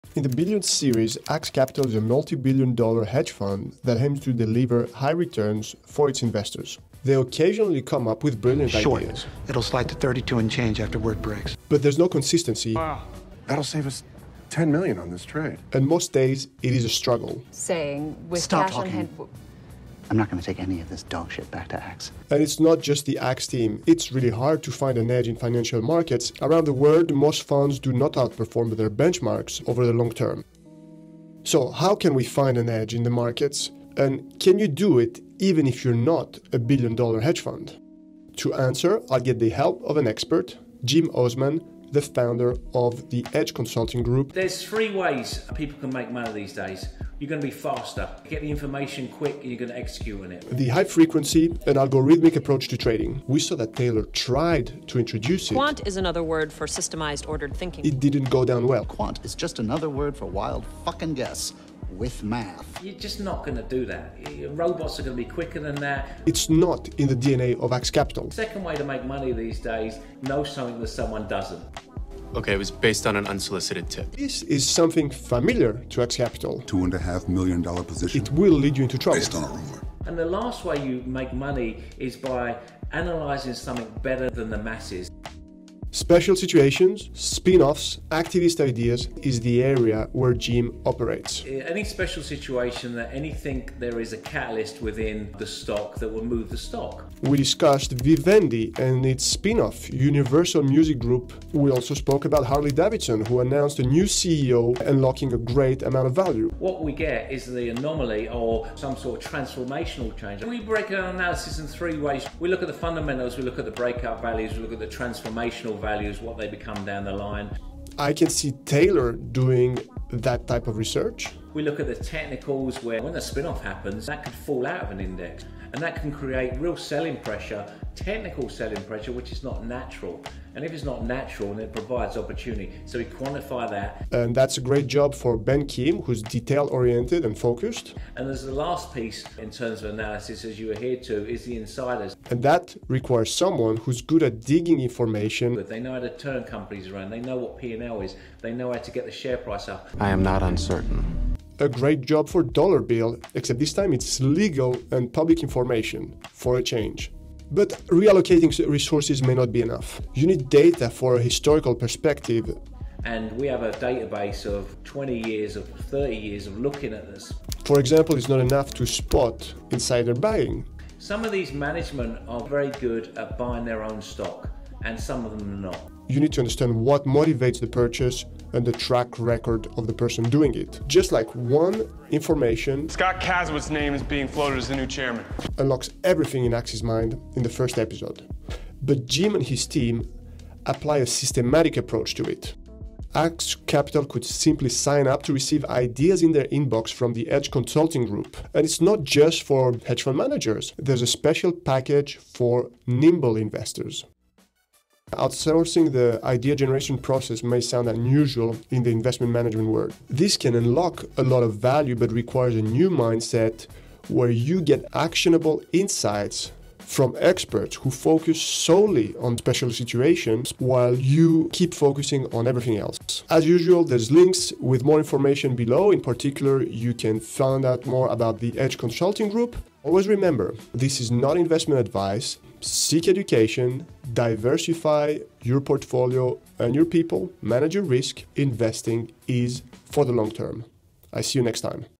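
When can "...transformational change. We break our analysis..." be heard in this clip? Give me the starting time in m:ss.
1:49.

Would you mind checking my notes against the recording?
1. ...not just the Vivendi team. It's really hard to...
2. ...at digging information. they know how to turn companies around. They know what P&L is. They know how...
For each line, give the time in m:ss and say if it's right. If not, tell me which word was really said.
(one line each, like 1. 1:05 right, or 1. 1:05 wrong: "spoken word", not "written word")
1. 0:22 wrong: "Axe", not "Vivendi"
2. 2:24 right.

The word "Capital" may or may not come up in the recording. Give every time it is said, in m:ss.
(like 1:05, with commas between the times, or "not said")
0:01, 1:07, 1:16, 3:13.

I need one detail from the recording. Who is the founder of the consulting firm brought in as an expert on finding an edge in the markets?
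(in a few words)
Jim Osman.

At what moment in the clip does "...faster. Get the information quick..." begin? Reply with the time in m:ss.
0:47.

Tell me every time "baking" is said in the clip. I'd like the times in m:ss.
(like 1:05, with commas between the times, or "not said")
not said.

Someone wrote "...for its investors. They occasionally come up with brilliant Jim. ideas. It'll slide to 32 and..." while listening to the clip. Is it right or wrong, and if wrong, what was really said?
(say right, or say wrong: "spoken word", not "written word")
wrong: "Short", not "Jim".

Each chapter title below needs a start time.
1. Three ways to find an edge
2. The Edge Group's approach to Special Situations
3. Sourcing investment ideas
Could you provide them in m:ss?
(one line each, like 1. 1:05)
1. 0:47
2. 1:51
3. 3:13.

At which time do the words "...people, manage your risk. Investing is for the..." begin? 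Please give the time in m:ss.
3:56.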